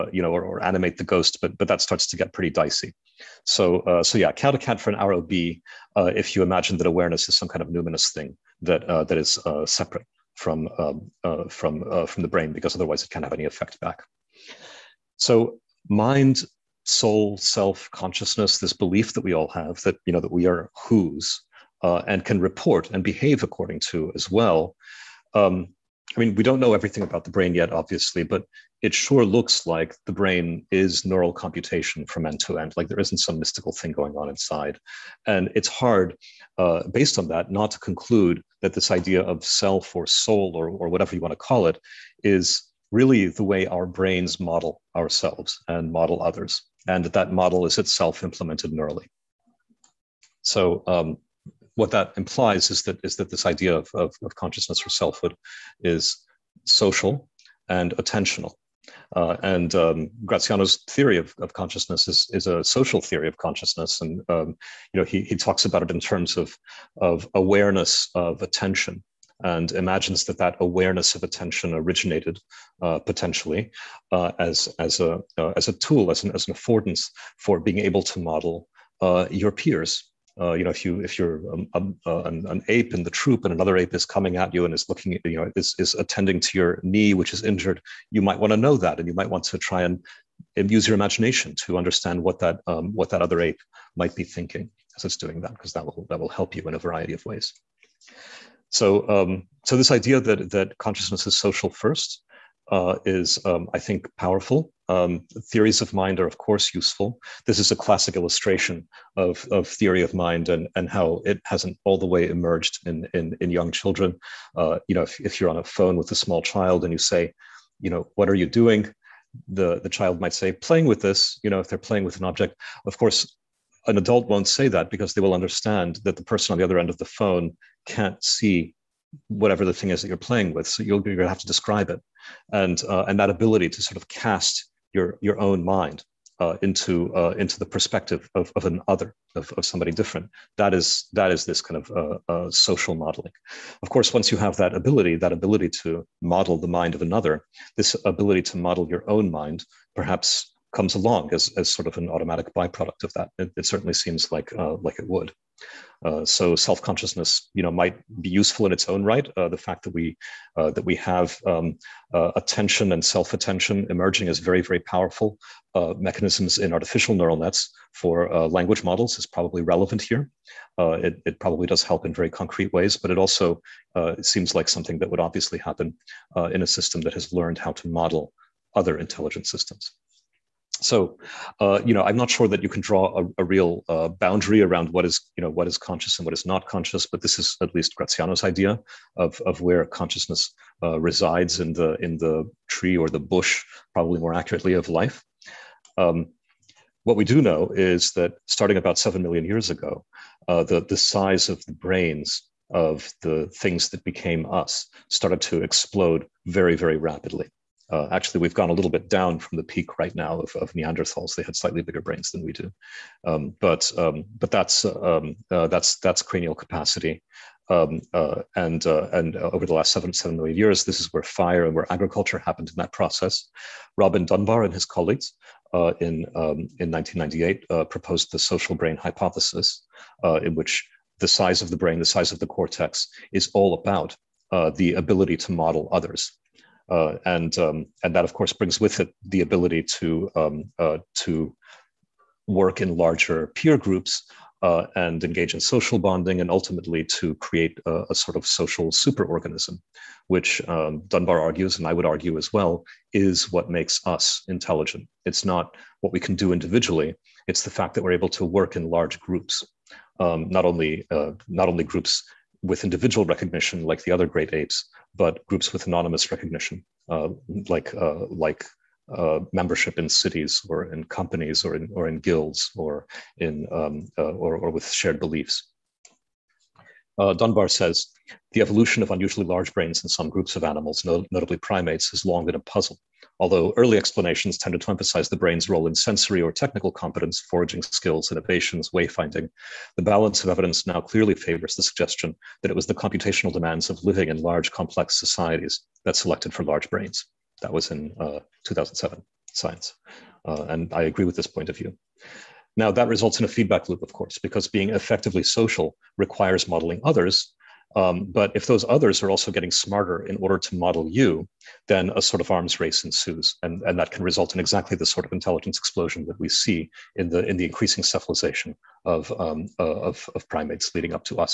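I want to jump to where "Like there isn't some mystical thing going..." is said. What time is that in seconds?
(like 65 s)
32 s.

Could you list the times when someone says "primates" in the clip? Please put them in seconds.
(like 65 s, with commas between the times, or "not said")
281 s, 320 s.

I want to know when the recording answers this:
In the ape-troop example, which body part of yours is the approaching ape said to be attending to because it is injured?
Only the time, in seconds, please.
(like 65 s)
86 s.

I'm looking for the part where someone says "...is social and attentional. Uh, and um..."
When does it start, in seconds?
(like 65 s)
55 s.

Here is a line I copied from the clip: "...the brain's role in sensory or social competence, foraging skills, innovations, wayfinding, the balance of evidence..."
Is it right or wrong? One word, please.
wrong.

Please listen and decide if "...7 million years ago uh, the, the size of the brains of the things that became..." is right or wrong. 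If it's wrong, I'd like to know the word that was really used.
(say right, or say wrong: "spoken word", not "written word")
right.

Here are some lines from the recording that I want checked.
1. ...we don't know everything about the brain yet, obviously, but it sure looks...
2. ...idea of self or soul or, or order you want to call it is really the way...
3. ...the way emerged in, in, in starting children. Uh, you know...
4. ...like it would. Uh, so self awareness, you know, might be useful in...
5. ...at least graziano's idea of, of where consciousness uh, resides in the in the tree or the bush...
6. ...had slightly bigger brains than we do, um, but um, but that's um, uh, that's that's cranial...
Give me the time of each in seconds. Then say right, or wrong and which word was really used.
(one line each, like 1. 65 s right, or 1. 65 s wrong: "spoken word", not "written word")
1. 26 s right
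2. 38 s wrong: "whatever", not "order"
3. 111 s wrong: "young", not "starting"
4. 154 s wrong: "consciousness", not "awareness"
5. 187 s right
6. 211 s right.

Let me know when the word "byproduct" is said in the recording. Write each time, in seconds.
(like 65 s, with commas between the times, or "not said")
152 s.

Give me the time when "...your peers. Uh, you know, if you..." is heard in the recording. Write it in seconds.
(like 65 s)
79 s.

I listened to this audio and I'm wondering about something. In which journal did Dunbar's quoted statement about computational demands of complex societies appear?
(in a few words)
Science.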